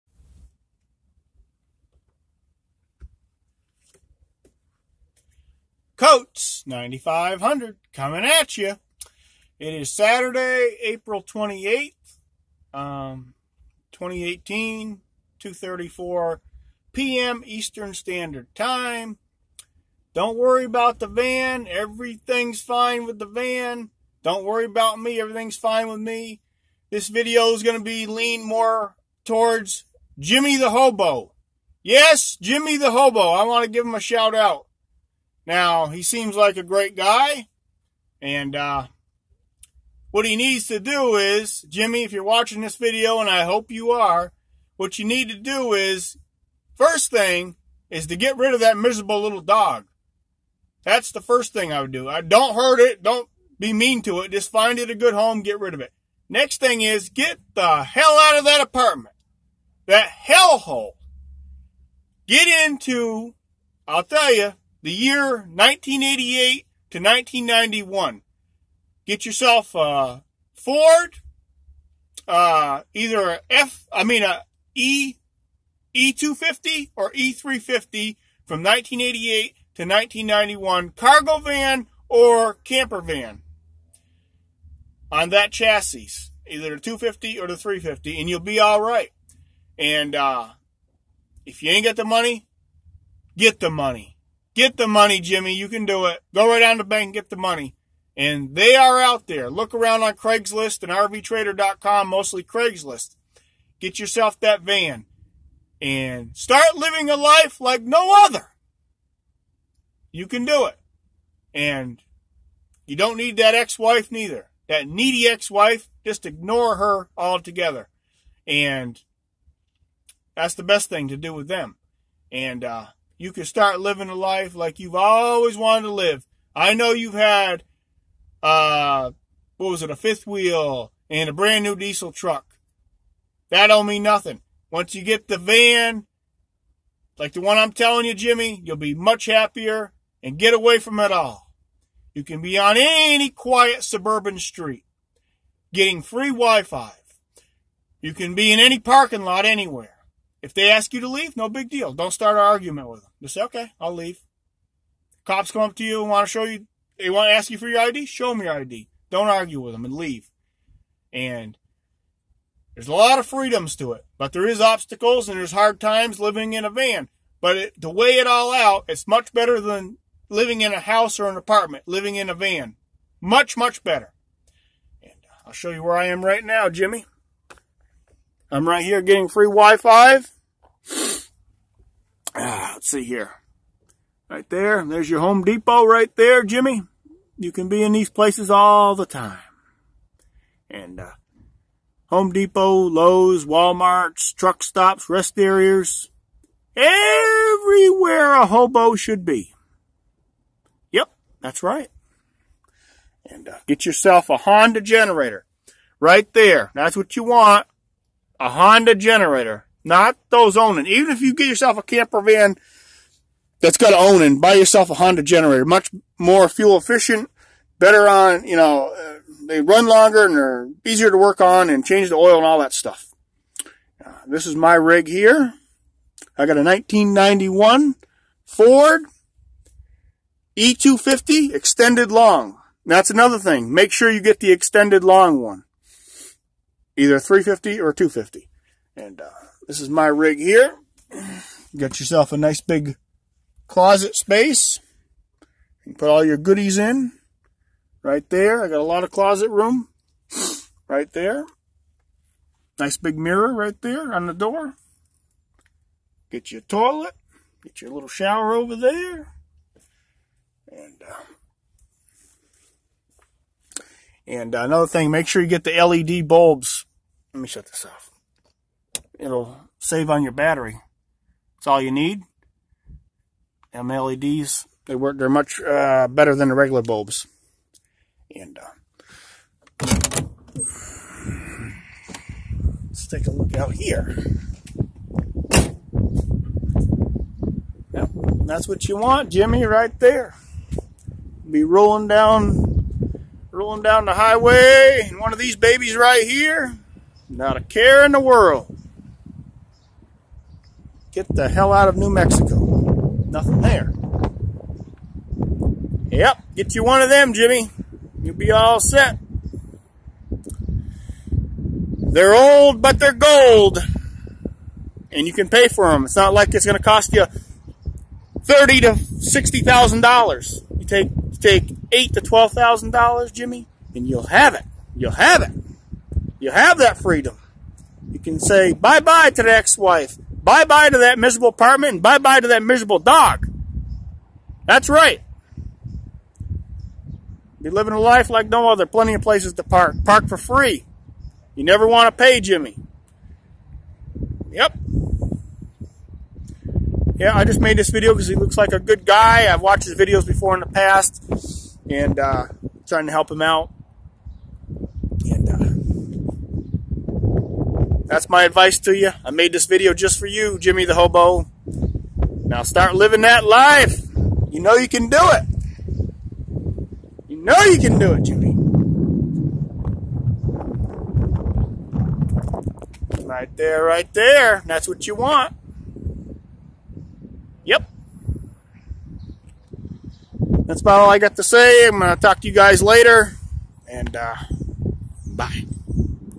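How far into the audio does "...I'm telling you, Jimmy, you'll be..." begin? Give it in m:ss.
2:17.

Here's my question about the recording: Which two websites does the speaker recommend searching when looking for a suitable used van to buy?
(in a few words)
Craigslist and RVTrader.com.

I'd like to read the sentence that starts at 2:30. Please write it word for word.
If they ask you to leave, no big deal.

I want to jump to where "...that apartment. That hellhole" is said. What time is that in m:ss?
0:58.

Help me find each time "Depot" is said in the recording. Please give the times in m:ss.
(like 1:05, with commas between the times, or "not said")
3:05, 3:12.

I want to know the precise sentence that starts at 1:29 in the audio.
And uh, if you ain't got the money, get the money.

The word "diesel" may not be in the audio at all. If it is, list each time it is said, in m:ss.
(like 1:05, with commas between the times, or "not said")
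2:11.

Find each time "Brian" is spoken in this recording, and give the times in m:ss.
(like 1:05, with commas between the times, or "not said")
not said.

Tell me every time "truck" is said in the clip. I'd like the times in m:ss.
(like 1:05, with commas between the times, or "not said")
2:12, 3:14.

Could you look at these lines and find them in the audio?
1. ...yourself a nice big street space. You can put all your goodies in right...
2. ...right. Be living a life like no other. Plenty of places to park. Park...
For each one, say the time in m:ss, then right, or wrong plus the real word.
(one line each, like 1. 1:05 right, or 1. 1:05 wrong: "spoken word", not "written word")
1. 4:01 wrong: "closet", not "street"
2. 5:34 right.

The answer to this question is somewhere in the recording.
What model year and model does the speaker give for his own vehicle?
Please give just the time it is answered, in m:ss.
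3:46.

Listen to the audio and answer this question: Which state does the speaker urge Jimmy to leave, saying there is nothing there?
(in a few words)
New Mexico.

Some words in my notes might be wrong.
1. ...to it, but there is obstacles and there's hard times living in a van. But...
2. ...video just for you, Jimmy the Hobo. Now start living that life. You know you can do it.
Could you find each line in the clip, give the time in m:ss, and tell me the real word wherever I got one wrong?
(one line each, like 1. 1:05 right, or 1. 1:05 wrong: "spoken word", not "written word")
1. 2:43 right
2. 5:59 right.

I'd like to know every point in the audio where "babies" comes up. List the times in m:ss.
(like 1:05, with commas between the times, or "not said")
4:55.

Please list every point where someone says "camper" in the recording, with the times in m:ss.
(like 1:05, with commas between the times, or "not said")
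1:22, 3:31.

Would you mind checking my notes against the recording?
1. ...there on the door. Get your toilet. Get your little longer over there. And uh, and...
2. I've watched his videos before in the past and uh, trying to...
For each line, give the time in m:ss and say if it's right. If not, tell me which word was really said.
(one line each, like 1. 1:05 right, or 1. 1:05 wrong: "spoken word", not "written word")
1. 4:13 wrong: "shower", not "longer"
2. 5:49 right.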